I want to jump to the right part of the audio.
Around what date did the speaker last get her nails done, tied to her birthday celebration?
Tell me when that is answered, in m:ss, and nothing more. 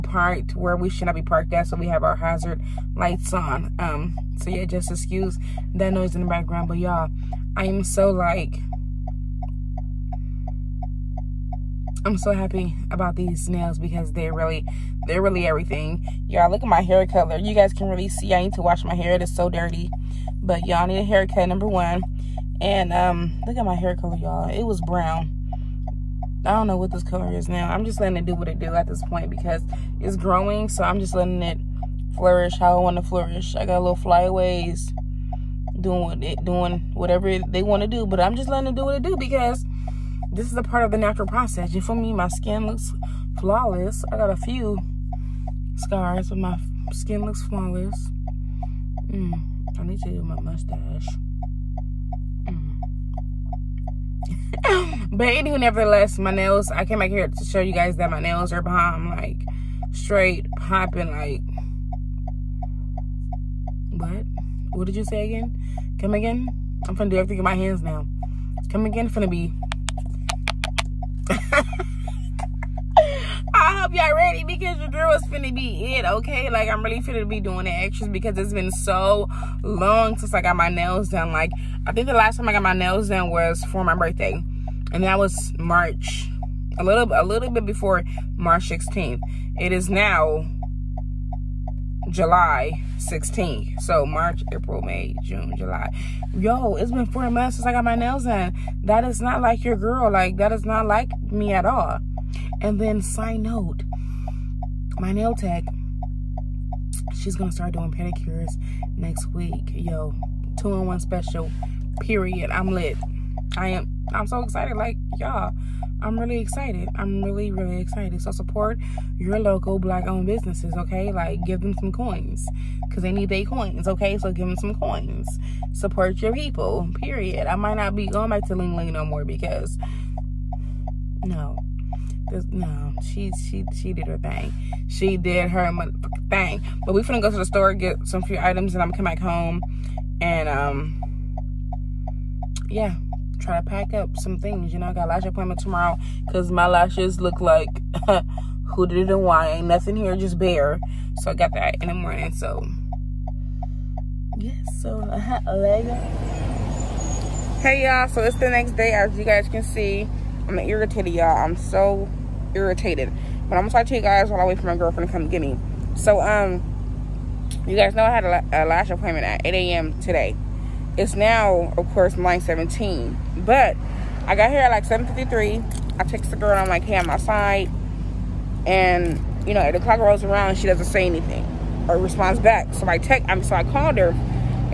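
1:28.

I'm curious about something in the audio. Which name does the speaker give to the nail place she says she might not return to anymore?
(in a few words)
Ling Ling.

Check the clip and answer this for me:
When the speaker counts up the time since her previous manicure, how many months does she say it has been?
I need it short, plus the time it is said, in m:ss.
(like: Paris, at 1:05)
4, at 1:37.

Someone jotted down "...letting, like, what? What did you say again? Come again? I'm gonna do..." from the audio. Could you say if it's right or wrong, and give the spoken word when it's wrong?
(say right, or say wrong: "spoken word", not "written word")
wrong: "popping", not "letting".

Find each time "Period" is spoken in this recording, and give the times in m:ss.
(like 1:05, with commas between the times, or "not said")
1:51, 2:06.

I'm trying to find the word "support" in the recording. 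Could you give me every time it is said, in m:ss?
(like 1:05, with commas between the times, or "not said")
1:58, 2:05.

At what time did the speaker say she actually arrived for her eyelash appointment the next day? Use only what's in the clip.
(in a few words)
7:53.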